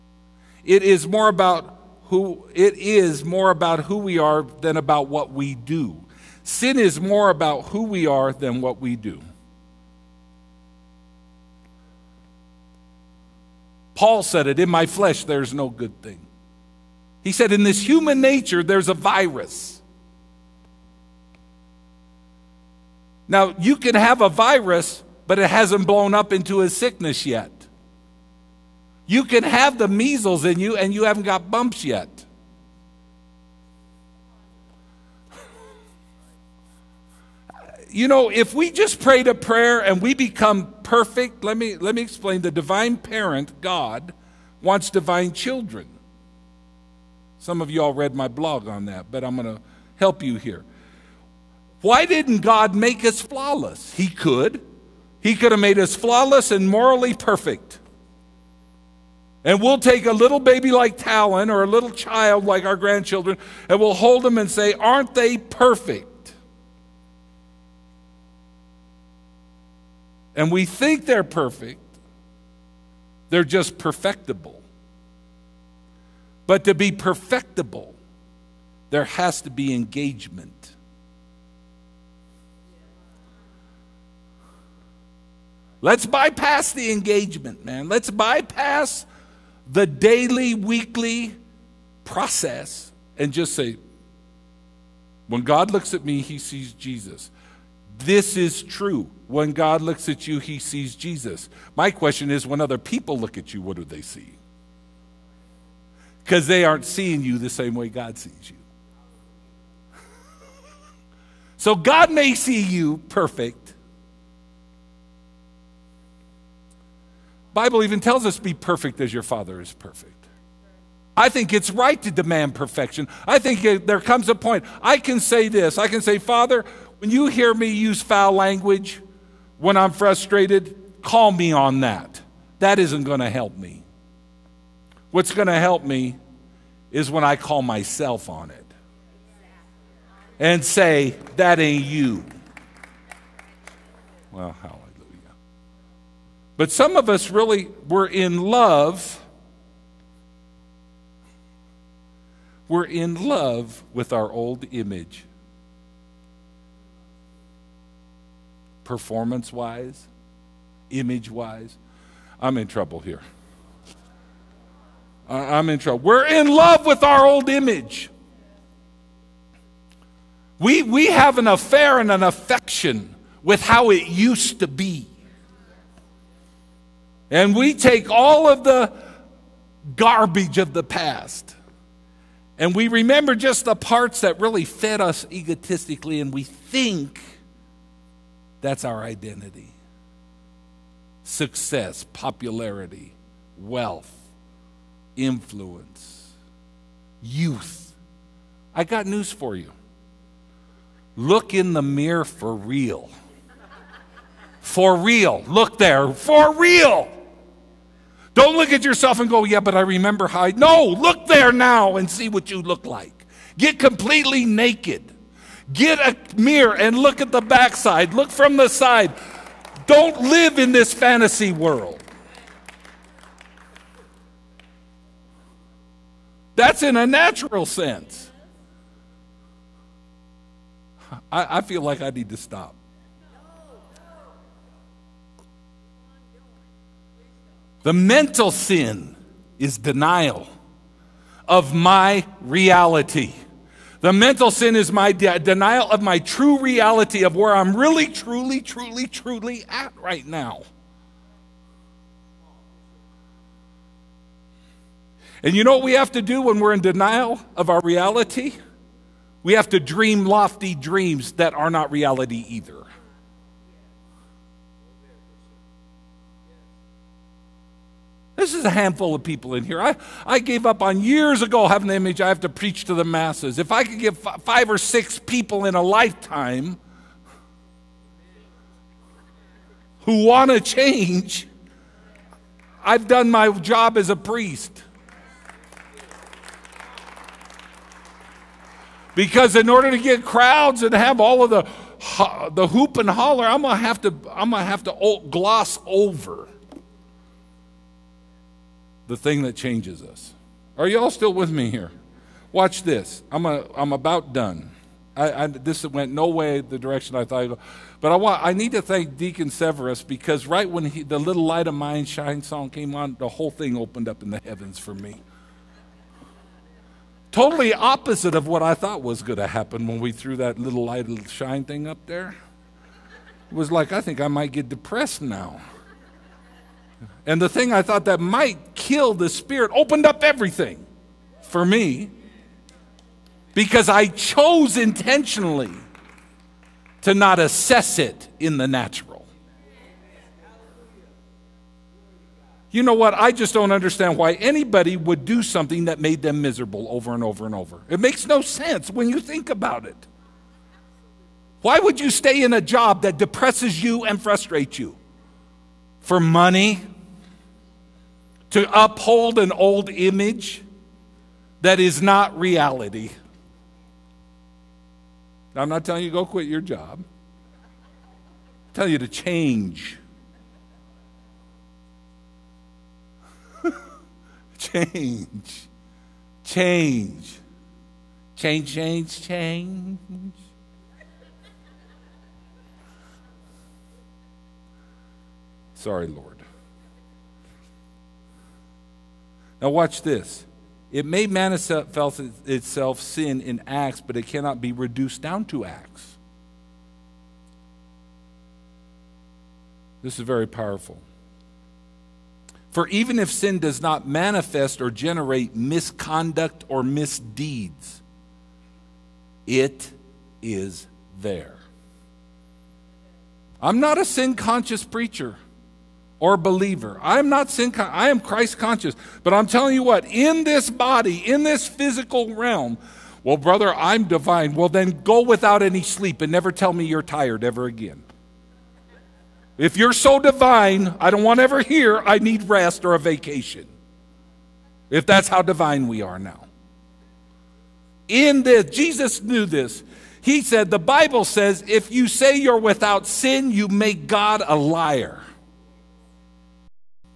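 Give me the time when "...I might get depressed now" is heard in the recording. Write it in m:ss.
5:24.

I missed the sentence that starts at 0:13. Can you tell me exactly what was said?
Paul said it, in my flesh there's no good thing.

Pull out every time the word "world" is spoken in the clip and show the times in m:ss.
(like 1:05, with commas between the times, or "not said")
3:41.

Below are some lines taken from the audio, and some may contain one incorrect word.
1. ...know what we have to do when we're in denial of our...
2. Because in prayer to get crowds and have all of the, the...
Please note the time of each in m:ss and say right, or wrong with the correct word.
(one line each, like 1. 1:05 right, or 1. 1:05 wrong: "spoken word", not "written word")
1. 4:15 right
2. 4:49 wrong: "order", not "prayer".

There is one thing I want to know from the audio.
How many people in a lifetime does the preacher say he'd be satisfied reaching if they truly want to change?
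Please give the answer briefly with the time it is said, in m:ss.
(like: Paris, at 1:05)
5 or 6, at 4:34.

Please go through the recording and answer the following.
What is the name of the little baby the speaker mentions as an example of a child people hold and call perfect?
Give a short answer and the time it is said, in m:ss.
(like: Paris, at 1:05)
Talon, at 1:00.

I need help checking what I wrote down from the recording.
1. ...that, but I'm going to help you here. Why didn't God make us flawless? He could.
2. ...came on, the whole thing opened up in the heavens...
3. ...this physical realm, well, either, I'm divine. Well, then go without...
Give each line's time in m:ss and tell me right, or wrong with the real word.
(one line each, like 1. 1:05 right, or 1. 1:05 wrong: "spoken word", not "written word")
1. 0:48 right
2. 5:12 right
3. 7:01 wrong: "brother", not "either".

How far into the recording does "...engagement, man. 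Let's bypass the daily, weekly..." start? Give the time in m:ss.
1:26.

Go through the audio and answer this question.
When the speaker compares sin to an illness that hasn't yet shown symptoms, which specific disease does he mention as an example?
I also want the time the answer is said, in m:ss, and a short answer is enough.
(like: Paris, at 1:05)
measles, at 0:29.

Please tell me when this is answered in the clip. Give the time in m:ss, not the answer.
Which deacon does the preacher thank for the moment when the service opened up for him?
5:09.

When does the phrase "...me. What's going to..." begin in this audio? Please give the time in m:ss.
2:13.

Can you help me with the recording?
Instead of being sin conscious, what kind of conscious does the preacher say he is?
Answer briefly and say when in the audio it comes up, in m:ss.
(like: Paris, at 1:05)
Christ conscious, at 6:58.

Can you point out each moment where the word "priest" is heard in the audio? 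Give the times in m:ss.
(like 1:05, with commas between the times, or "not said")
4:44.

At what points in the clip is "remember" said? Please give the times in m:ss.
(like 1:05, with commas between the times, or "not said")
3:02, 3:29.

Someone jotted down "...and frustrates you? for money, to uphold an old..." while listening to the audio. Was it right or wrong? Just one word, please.
right.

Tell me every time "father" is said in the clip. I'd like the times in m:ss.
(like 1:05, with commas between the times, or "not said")
1:59, 2:06.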